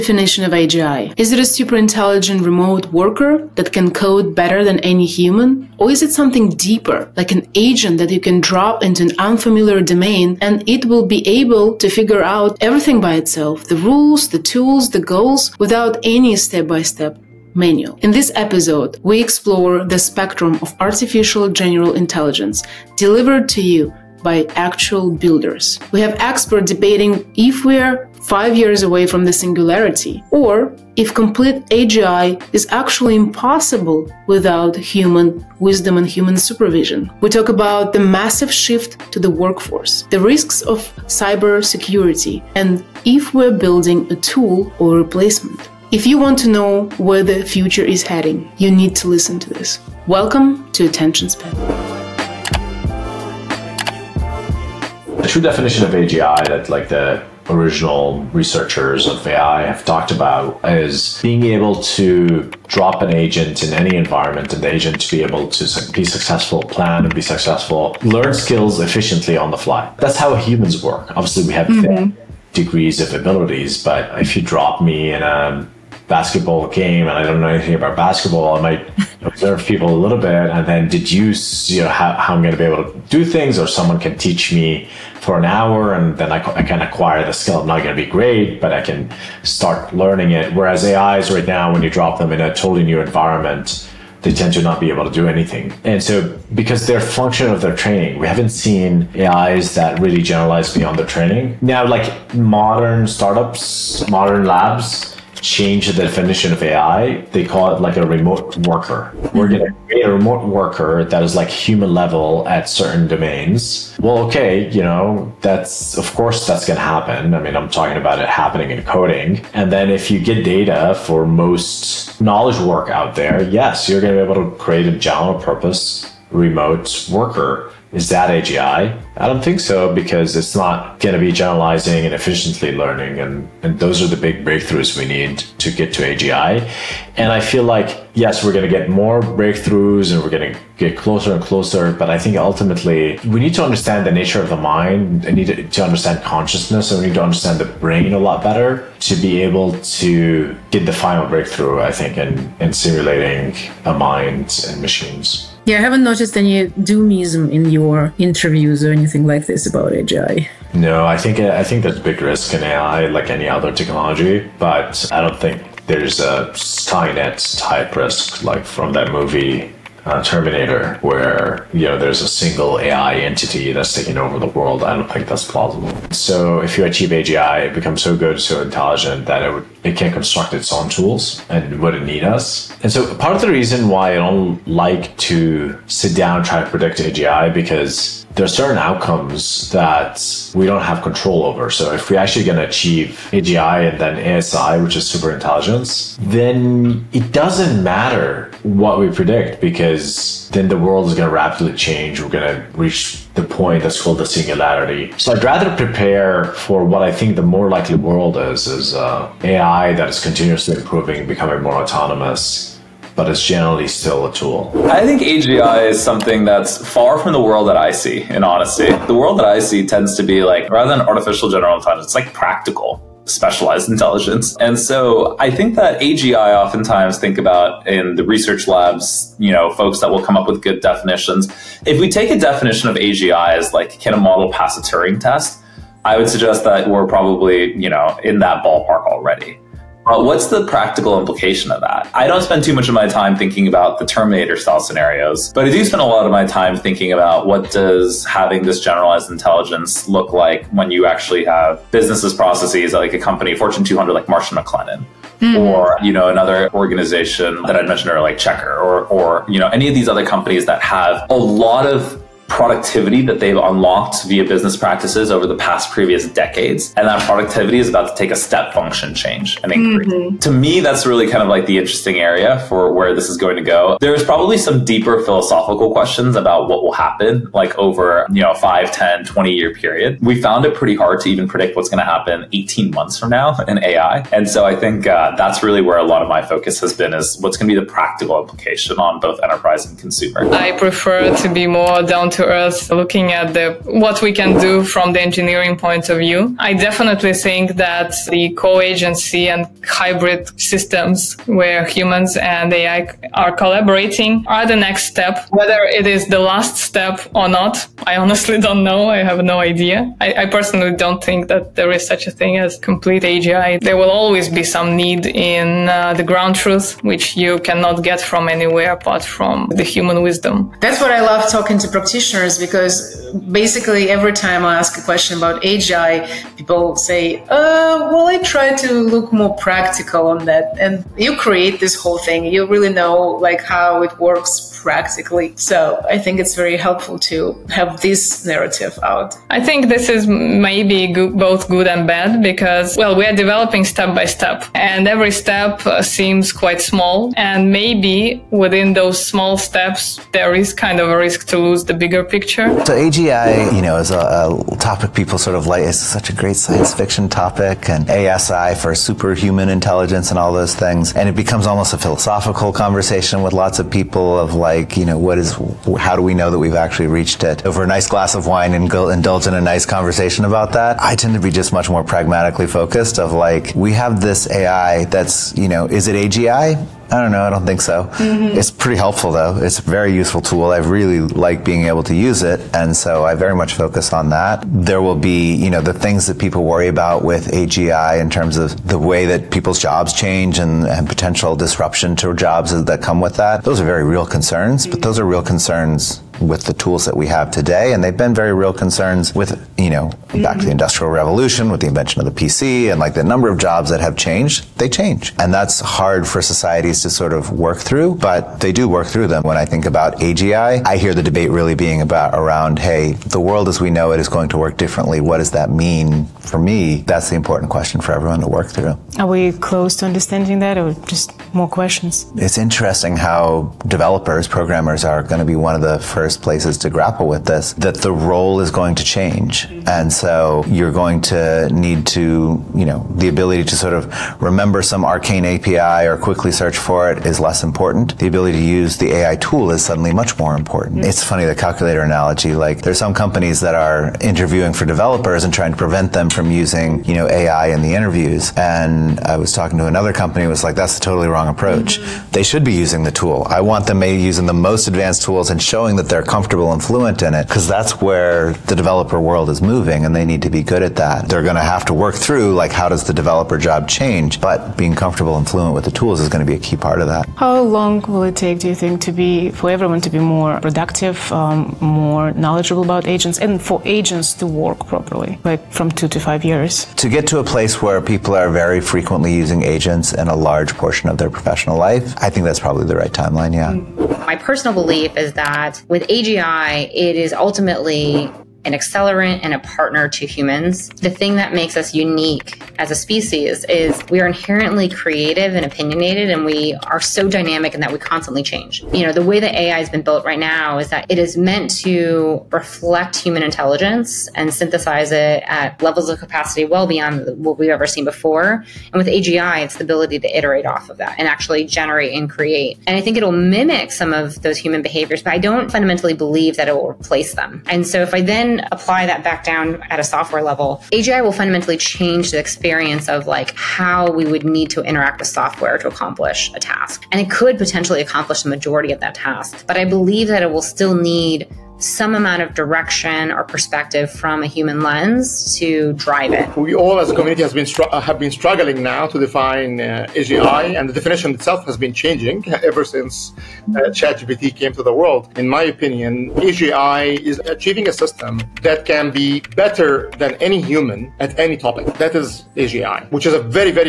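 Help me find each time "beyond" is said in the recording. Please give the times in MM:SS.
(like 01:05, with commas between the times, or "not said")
01:40, 08:26.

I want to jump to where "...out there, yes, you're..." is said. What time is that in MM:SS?
02:02.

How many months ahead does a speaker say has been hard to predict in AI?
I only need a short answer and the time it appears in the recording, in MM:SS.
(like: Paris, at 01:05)
18 months, at 04:42.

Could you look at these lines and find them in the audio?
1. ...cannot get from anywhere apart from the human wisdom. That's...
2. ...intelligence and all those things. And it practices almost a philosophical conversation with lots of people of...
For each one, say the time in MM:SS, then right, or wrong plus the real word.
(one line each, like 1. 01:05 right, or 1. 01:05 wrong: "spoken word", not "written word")
1. 05:17 right
2. 05:59 wrong: "becomes", not "practices".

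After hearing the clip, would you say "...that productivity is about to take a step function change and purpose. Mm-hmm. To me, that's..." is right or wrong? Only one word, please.
wrong.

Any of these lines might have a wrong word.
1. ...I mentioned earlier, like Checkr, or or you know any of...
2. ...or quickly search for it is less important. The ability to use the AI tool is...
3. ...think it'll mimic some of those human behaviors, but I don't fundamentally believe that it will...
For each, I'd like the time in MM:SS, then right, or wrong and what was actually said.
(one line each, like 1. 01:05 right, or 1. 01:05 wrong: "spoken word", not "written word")
1. 04:17 right
2. 07:16 right
3. 08:32 right.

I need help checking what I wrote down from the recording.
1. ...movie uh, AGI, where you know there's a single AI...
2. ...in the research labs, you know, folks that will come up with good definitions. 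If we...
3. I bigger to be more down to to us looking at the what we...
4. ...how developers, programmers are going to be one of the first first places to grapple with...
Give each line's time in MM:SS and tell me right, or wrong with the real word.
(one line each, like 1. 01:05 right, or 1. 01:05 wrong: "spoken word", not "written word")
1. 02:49 wrong: "Terminator", not "AGI"
2. 03:47 right
3. 04:50 wrong: "prefer", not "bigger"
4. 07:03 right.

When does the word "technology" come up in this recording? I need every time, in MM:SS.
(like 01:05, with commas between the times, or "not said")
02:43.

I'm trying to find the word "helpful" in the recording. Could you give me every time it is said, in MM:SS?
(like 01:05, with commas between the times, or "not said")
05:36, 06:18.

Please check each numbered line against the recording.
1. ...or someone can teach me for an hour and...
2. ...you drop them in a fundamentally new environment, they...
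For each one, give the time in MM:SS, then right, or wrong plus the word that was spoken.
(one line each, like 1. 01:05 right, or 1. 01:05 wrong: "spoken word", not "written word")
1. 01:23 right
2. 01:31 wrong: "totally", not "fundamentally".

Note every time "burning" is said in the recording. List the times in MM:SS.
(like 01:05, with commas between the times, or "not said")
not said.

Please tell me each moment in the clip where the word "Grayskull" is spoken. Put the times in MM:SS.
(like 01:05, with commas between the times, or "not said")
not said.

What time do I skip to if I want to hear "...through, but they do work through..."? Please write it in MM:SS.
06:47.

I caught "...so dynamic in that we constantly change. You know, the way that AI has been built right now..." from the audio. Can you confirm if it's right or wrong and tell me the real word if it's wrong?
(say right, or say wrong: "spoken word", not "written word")
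right.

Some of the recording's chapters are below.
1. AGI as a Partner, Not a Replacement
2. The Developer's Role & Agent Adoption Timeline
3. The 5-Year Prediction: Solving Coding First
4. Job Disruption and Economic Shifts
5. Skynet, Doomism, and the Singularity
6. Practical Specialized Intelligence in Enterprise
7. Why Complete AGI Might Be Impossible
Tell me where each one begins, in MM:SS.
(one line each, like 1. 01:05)
1. 08:04
2. 07:01
3. 08:56
4. 05:52
5. 02:35
6. 03:35
7. 04:50.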